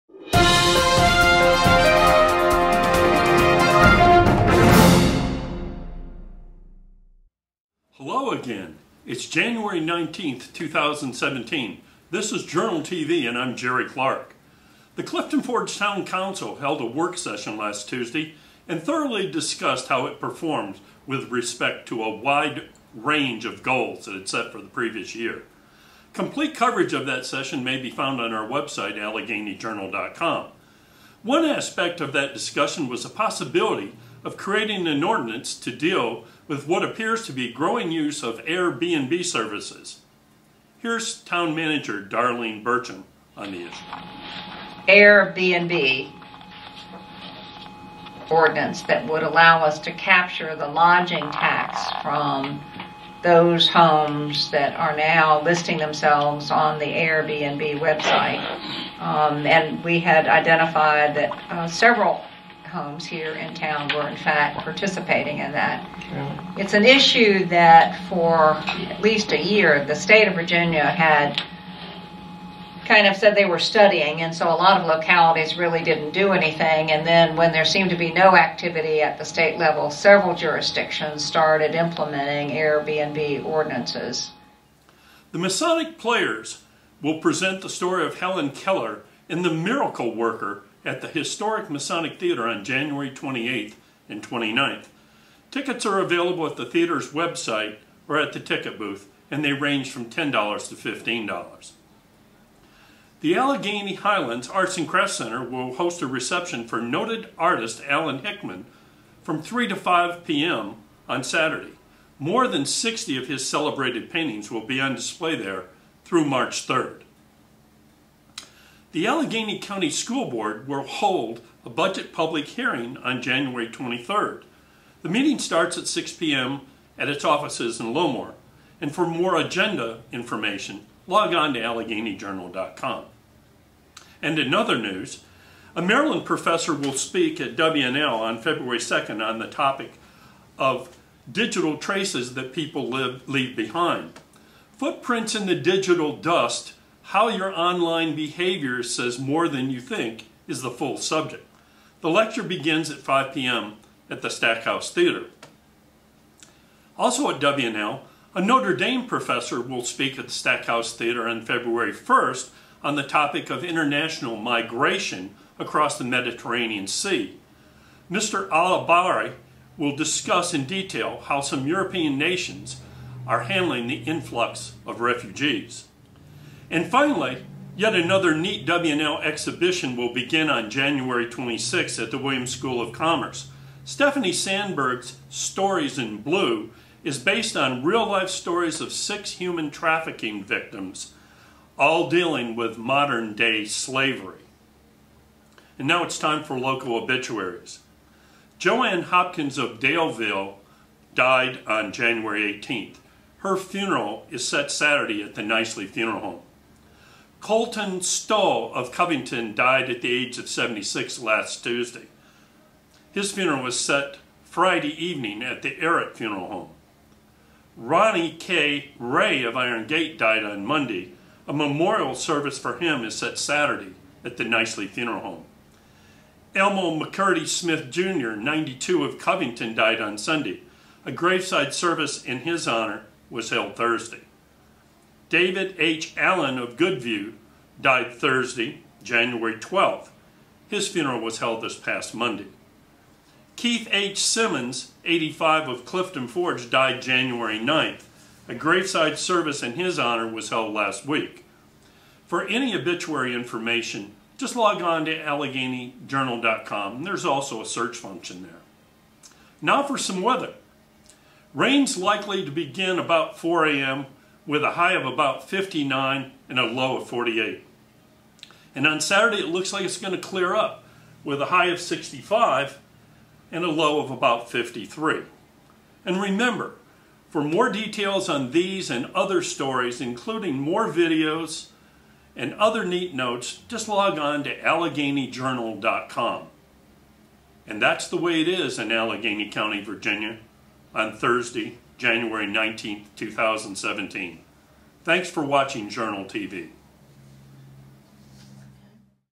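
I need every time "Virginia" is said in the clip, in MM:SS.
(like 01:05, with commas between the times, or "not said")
01:10, 04:49.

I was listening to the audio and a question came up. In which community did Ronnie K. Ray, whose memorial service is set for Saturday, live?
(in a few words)
Iron Gate.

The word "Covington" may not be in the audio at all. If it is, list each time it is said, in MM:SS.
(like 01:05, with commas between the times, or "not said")
03:28, 03:49.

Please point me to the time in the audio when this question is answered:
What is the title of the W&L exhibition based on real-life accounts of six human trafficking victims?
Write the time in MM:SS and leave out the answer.
03:05.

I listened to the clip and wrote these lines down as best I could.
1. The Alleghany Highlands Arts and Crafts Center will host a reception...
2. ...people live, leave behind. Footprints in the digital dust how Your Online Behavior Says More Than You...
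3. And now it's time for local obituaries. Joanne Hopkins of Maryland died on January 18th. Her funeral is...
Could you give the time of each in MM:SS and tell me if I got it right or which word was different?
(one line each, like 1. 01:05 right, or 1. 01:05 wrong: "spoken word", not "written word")
1. 01:43 right
2. 02:22 right
3. 03:15 wrong: "Daleville", not "Maryland".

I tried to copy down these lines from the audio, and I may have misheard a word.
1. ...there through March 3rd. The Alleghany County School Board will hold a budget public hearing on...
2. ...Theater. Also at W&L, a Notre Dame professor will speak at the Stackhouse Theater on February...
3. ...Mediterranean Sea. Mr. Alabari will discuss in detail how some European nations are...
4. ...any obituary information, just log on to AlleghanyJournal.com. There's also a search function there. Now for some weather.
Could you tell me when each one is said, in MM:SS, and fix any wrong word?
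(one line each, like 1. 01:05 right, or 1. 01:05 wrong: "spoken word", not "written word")
1. 01:55 right
2. 02:34 right
3. 02:46 right
4. 04:12 right.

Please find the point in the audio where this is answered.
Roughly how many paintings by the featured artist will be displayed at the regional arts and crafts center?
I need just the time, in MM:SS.
01:52.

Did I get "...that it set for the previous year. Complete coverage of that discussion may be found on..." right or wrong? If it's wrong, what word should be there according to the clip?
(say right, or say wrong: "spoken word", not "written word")
wrong: "session", not "discussion".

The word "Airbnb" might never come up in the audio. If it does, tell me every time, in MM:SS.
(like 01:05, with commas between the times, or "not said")
00:38, 00:44, 00:56, 01:22.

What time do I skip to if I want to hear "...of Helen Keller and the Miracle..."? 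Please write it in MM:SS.
01:28.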